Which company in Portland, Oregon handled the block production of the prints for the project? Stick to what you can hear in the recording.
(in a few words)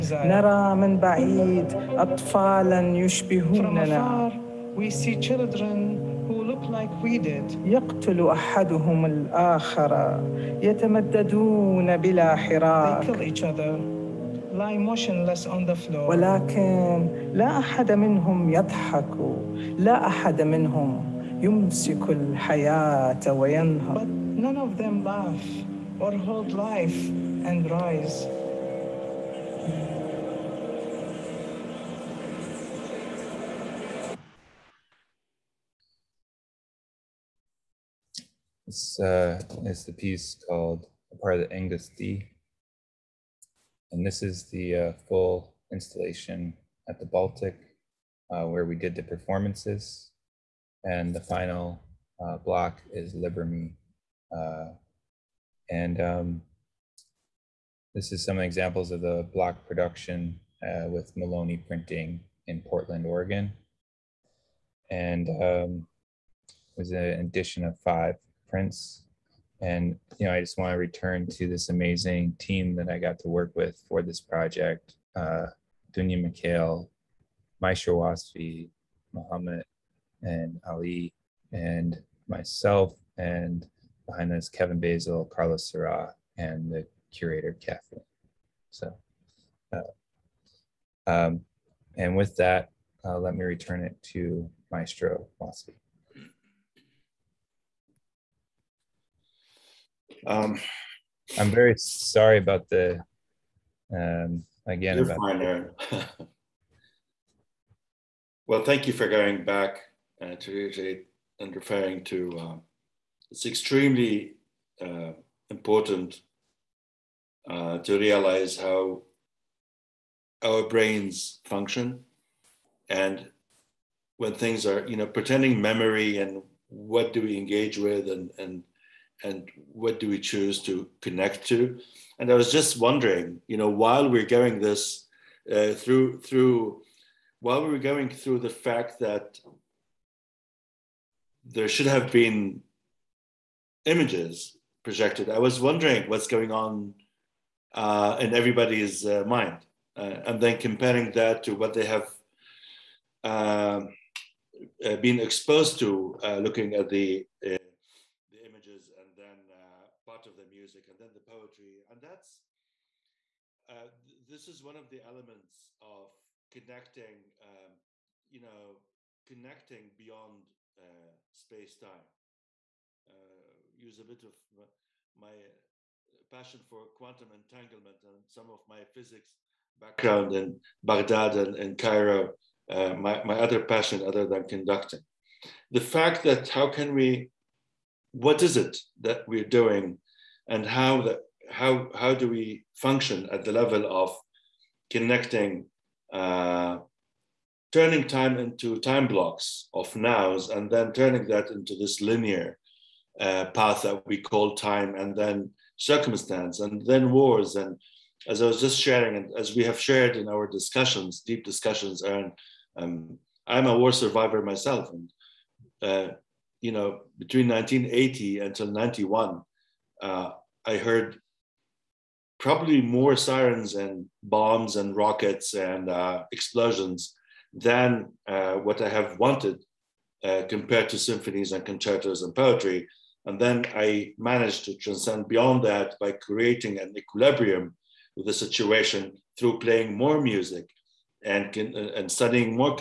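Maloney Printing.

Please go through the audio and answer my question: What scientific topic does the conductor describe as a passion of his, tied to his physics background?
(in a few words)
Quantum entanglement.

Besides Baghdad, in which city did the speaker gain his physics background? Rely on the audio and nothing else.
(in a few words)
Cairo.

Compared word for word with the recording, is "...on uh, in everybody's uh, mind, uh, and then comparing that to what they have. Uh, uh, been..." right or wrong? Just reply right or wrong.
right.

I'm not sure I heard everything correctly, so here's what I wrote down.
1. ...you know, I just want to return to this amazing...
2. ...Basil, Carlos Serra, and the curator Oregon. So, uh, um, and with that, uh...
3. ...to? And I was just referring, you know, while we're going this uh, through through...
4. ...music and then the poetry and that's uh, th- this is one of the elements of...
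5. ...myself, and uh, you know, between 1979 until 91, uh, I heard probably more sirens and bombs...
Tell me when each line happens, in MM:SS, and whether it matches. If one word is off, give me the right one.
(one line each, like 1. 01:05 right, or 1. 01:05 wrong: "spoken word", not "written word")
1. 01:10 right
2. 01:24 wrong: "Kathleen", not "Oregon"
3. 02:11 wrong: "wondering", not "referring"
4. 02:40 right
5. 03:34 wrong: "1980", not "1979".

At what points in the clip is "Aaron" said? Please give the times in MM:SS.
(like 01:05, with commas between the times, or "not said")
01:45, 03:32.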